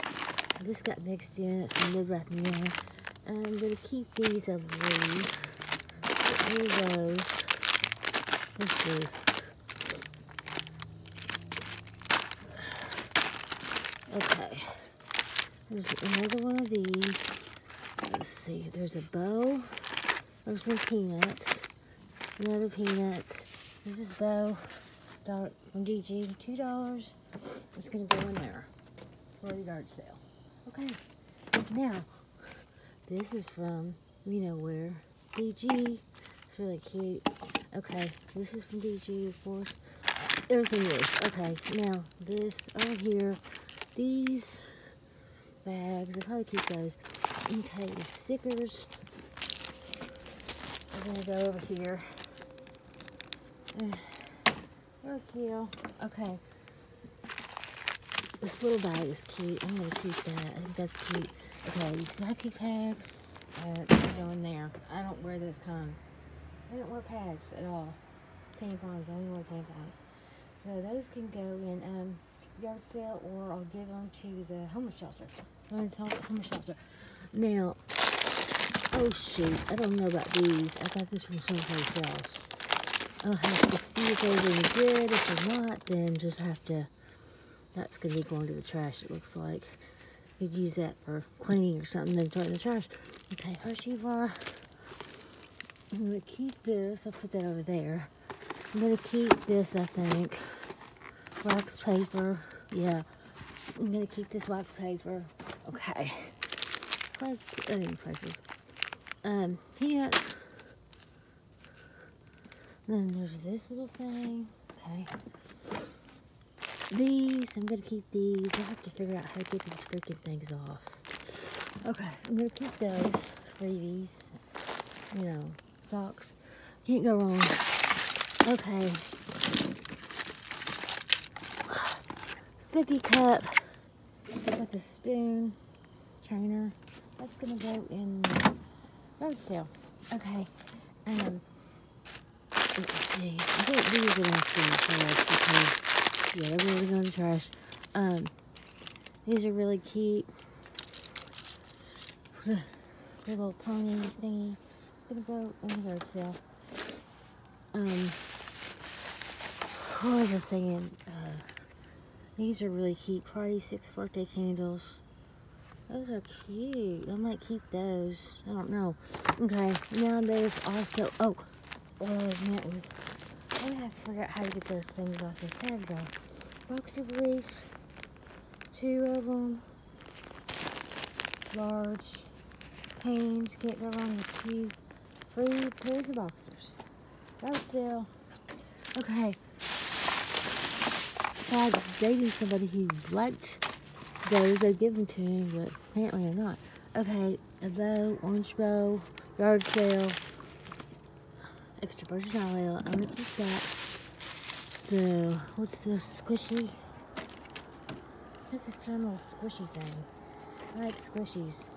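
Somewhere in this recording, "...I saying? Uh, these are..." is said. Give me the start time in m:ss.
2:40.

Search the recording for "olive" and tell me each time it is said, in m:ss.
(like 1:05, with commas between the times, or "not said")
3:22.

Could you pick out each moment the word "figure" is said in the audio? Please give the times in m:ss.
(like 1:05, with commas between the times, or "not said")
1:58, 2:54.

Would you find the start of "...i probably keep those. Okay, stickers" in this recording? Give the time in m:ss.
0:46.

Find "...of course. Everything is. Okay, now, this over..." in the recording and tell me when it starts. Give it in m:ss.
0:39.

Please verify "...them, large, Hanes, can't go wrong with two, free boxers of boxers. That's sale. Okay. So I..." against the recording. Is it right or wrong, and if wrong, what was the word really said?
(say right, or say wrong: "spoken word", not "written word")
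wrong: "pairs", not "boxers".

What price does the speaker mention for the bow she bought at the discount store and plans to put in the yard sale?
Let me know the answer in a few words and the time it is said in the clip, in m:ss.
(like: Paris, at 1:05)
$2, at 0:26.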